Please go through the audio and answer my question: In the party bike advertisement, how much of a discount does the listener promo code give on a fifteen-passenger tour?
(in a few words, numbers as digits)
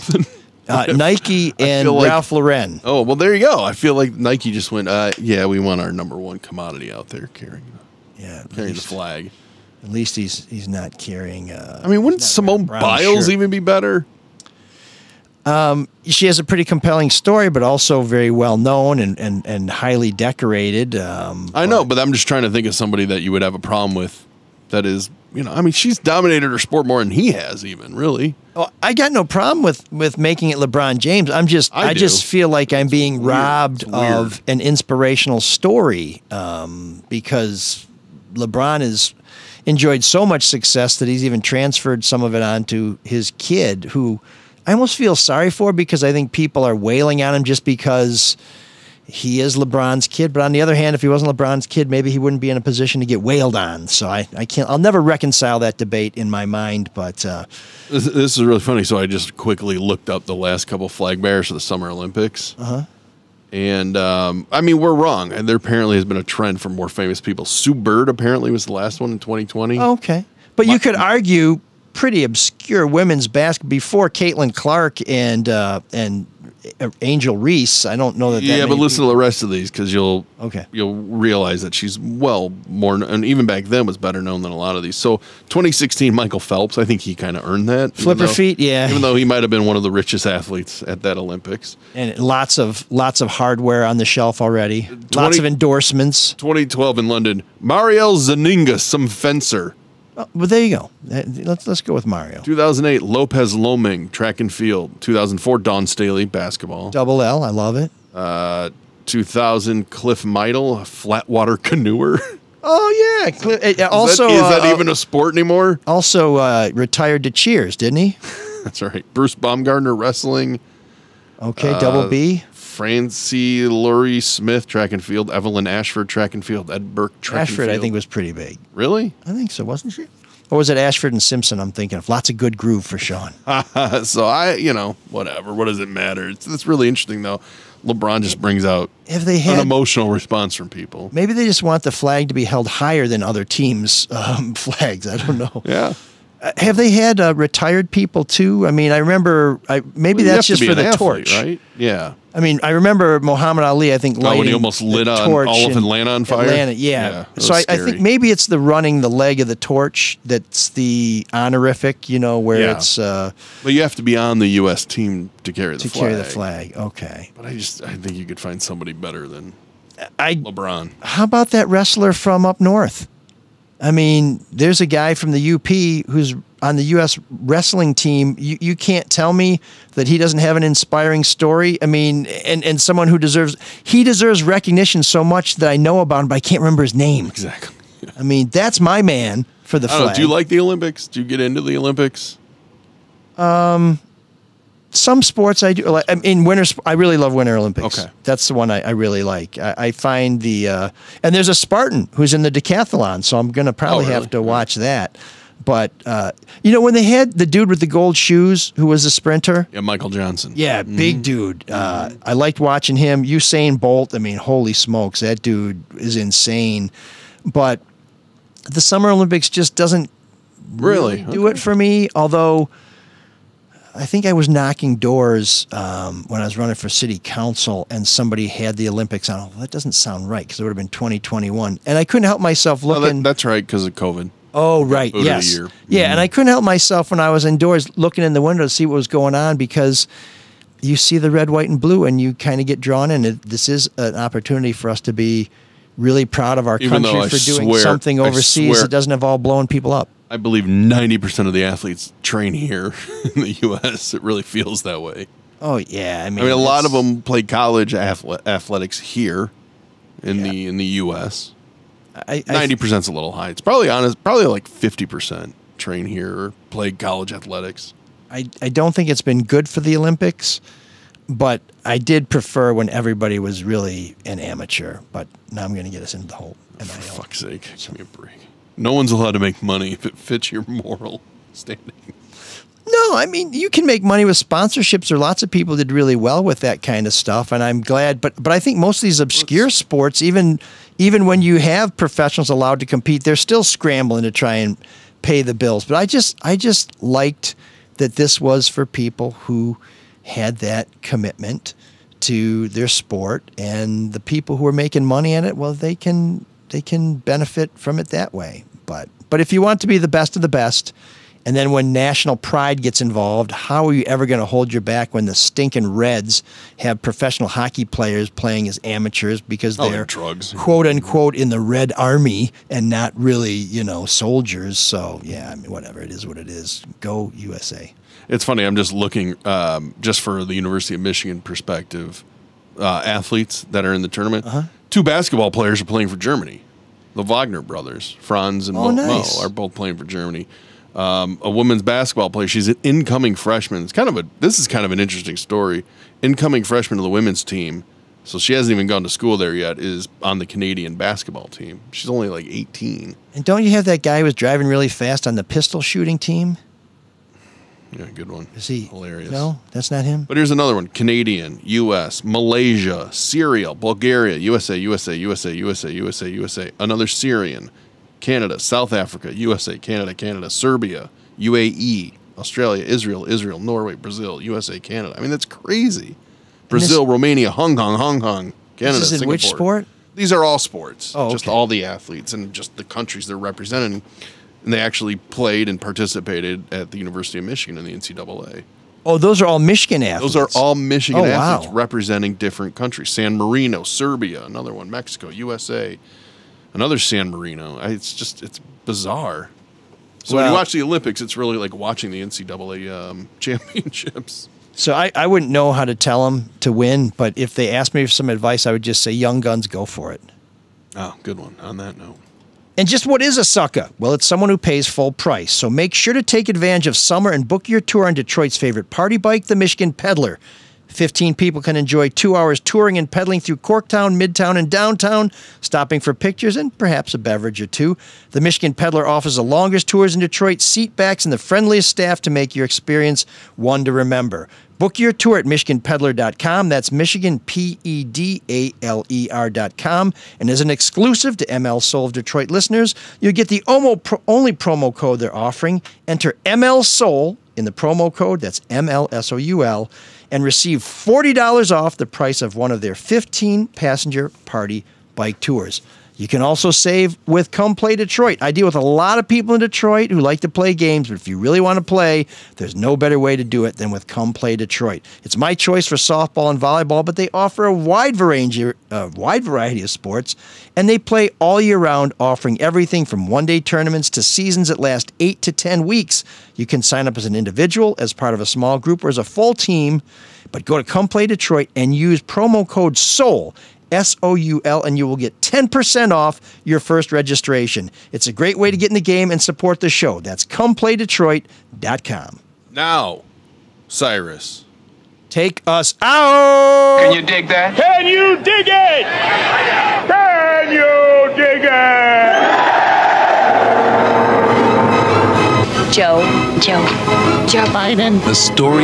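$40.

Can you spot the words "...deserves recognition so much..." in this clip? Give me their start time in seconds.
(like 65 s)
184 s.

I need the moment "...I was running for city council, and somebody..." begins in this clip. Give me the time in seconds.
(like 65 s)
226 s.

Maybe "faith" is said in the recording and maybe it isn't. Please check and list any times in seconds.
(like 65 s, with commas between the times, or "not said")
not said.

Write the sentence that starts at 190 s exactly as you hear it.
Know, do you like the Olympics?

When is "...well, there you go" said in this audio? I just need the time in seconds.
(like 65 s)
3 s.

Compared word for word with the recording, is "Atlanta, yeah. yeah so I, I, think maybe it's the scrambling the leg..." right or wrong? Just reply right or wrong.
wrong.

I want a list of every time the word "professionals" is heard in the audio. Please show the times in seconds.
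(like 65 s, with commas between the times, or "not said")
291 s, 317 s.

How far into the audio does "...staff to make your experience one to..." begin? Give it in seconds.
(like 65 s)
431 s.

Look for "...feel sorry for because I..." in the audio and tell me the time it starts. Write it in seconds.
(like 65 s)
44 s.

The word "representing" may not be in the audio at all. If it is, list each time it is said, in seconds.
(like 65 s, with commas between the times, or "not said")
383 s, 391 s.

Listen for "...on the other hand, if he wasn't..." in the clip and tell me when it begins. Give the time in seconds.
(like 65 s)
50 s.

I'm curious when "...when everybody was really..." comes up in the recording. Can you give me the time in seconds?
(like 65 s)
272 s.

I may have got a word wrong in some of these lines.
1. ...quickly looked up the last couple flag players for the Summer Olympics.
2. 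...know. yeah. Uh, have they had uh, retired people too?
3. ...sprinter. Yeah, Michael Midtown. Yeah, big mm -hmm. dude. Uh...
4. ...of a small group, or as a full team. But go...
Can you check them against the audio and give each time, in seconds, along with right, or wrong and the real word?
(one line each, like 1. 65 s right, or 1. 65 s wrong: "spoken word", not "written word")
1. 59 s wrong: "bearers", not "players"
2. 145 s right
3. 209 s wrong: "Johnson", not "Midtown"
4. 478 s right.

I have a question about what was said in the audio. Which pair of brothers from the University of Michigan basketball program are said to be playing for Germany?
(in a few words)
Wagner brothers.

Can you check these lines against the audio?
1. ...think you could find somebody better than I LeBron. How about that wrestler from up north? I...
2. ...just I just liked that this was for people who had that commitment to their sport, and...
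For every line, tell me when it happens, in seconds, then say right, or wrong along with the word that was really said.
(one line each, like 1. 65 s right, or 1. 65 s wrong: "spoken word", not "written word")
1. 167 s right
2. 296 s right.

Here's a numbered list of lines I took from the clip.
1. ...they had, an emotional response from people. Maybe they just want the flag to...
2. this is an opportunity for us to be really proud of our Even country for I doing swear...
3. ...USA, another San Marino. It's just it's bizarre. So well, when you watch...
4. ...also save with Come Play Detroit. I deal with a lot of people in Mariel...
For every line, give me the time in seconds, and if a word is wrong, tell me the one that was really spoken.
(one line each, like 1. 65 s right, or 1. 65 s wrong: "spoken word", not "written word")
1. 139 s right
2. 243 s right
3. 395 s right
4. 456 s wrong: "Detroit", not "Mariel".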